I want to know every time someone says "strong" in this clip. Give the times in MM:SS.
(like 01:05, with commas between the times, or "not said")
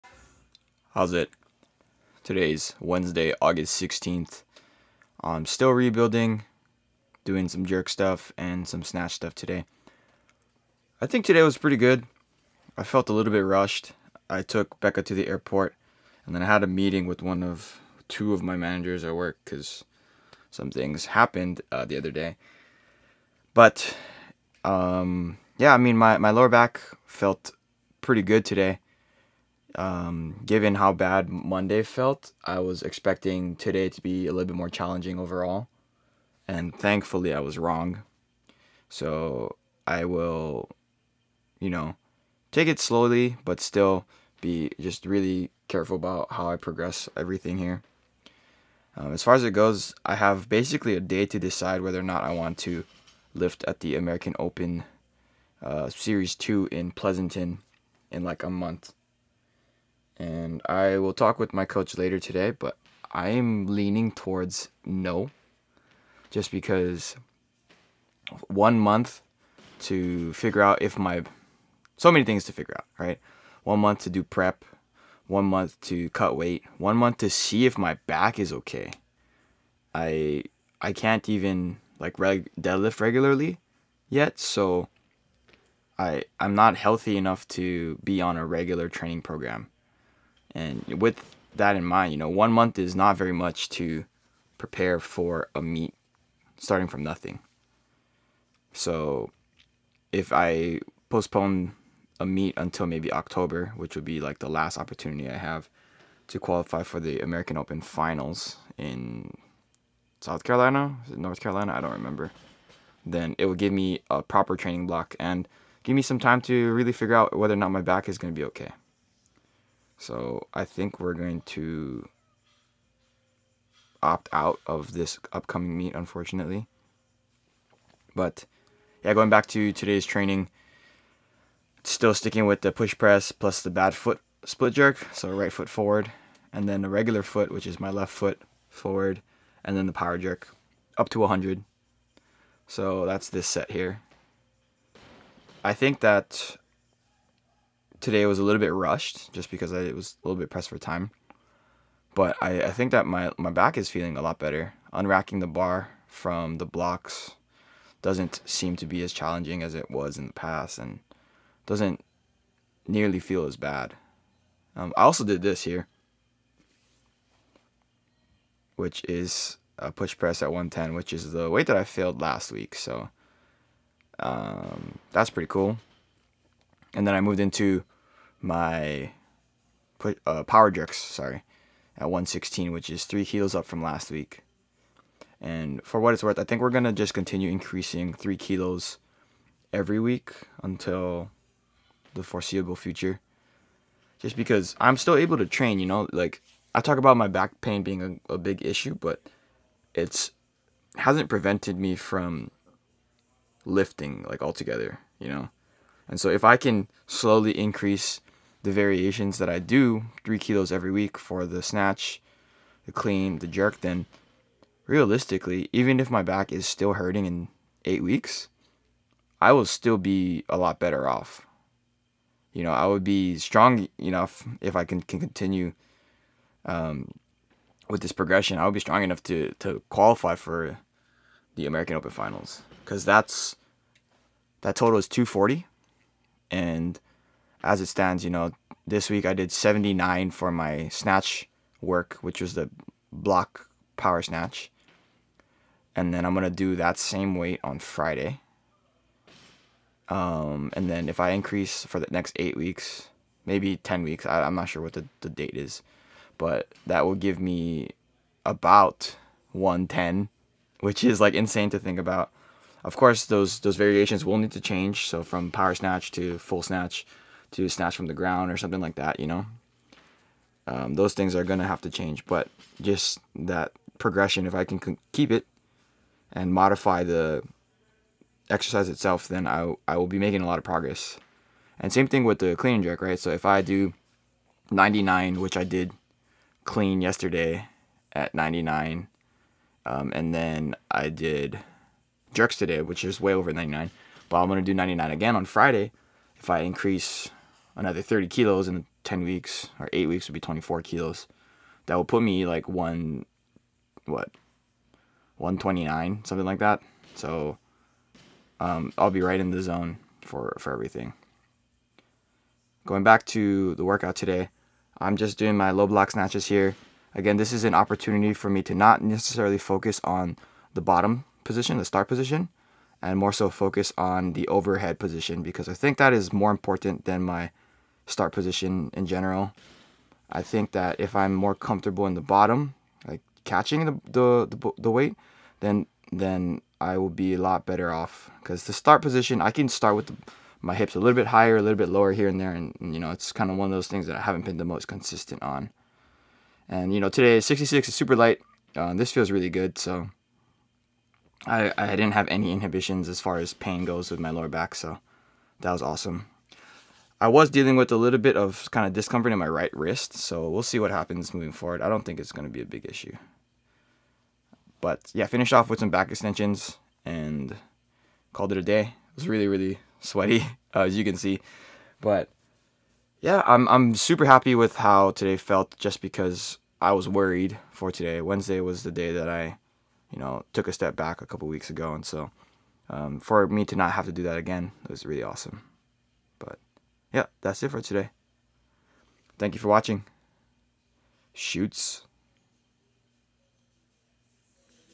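03:43, 03:48.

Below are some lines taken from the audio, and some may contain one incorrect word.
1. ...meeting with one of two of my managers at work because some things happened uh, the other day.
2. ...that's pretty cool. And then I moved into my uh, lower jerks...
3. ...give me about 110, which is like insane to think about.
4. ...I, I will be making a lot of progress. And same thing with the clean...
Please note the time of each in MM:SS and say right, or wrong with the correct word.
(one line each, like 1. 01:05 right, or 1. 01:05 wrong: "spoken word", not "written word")
1. 00:16 right
2. 02:55 wrong: "power", not "lower"
3. 04:17 right
4. 04:39 right.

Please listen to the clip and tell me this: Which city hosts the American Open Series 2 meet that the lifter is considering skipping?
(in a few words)
Pleasanton.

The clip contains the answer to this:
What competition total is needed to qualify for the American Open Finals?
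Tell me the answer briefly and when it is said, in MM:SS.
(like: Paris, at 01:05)
240, at 03:55.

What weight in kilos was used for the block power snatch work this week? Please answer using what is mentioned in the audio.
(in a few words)
79.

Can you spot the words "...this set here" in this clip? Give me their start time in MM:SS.
02:23.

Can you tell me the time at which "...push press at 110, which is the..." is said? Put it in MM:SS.
02:49.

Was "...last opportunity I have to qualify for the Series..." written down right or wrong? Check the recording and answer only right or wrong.
wrong.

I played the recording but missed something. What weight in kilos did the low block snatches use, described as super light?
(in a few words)
66.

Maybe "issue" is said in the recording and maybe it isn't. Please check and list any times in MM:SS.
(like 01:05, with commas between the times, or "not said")
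03:18, 06:02.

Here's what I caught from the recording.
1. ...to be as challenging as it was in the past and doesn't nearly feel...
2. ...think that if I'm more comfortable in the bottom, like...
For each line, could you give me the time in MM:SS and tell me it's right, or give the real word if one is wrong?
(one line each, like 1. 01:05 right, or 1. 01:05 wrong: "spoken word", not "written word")
1. 02:38 right
2. 05:30 right.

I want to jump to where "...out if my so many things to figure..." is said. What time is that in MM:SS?
01:10.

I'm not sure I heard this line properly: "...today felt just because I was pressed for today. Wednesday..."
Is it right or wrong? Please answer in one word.
wrong.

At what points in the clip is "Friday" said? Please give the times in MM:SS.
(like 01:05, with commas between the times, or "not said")
04:07, 04:55.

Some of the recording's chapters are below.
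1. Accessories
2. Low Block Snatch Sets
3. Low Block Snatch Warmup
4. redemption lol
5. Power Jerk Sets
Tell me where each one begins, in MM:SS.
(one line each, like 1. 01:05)
1. 05:54
2. 04:46
3. 03:53
4. 02:41
5. 02:58.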